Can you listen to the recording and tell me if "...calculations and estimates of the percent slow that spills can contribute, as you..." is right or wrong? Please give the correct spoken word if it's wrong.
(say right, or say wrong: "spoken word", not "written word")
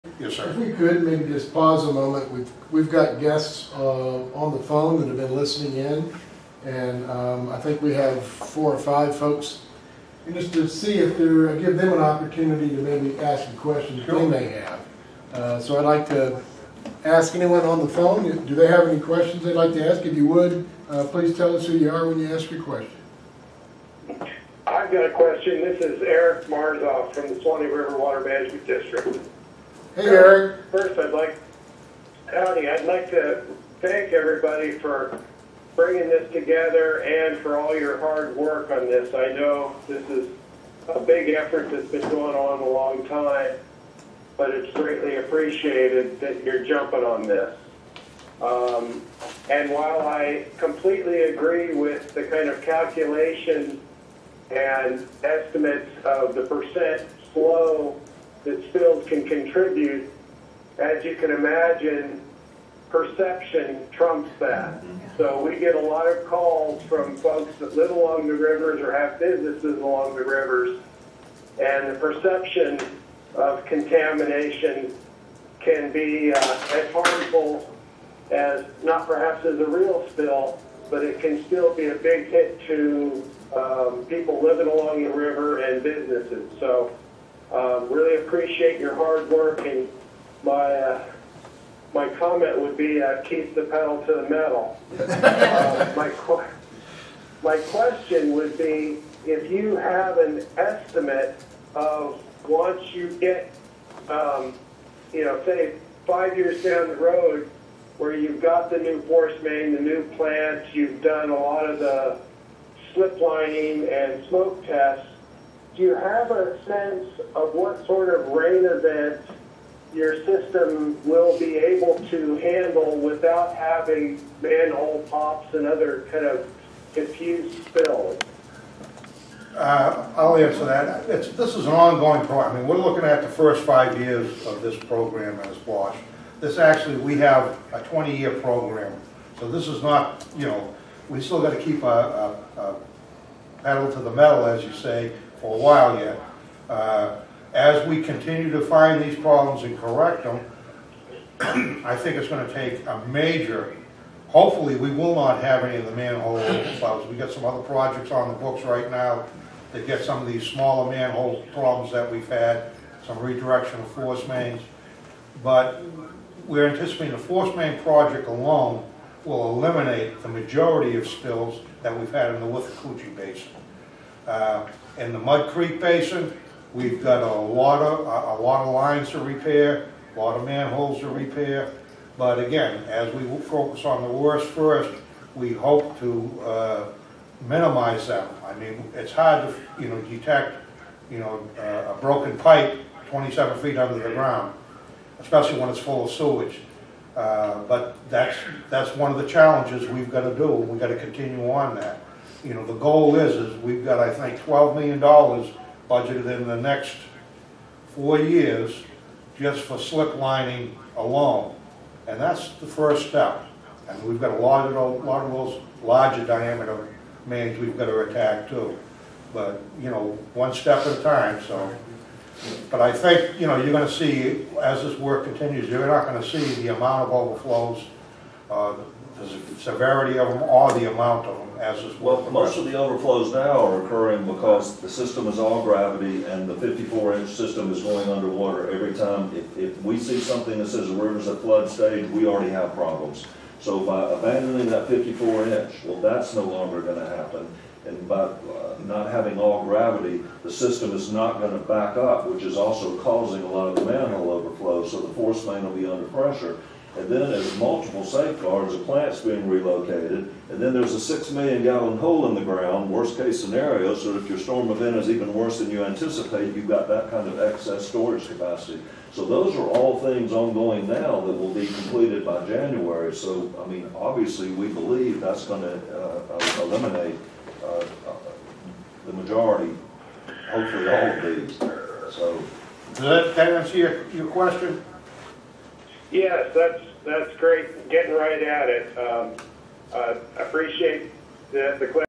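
right.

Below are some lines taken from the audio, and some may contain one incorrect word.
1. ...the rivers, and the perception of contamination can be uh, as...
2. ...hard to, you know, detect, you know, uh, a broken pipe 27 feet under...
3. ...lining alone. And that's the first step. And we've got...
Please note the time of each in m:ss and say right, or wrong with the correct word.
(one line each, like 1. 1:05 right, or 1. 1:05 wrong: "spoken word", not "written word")
1. 1:10 right
2. 3:09 right
3. 3:30 right.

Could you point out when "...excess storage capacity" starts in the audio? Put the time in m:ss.
4:27.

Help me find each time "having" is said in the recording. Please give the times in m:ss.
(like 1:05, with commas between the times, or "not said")
2:03, 4:09.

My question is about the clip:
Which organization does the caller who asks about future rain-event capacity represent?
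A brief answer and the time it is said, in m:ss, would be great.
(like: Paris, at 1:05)
Suwannee River Water Management District, at 0:27.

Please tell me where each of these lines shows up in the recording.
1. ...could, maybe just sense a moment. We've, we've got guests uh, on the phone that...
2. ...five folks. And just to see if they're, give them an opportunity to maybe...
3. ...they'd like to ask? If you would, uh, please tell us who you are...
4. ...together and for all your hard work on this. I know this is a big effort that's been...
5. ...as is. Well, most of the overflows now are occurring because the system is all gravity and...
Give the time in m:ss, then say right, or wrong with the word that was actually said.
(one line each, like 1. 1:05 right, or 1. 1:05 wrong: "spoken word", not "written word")
1. 0:00 wrong: "pause", not "sense"
2. 0:08 right
3. 0:19 right
4. 0:36 right
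5. 3:51 right.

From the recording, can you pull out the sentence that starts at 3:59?
If, if we see something that says the river's at flood stage, we already have problems.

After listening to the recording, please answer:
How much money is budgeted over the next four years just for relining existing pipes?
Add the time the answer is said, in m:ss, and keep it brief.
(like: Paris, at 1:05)
$12 million, at 3:24.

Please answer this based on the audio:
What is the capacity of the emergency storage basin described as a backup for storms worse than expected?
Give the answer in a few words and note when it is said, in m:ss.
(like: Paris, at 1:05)
6 million gallons, at 4:20.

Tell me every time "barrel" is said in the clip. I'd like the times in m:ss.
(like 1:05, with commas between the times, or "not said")
not said.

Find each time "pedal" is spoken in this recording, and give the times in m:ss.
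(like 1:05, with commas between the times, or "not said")
1:33, 2:23.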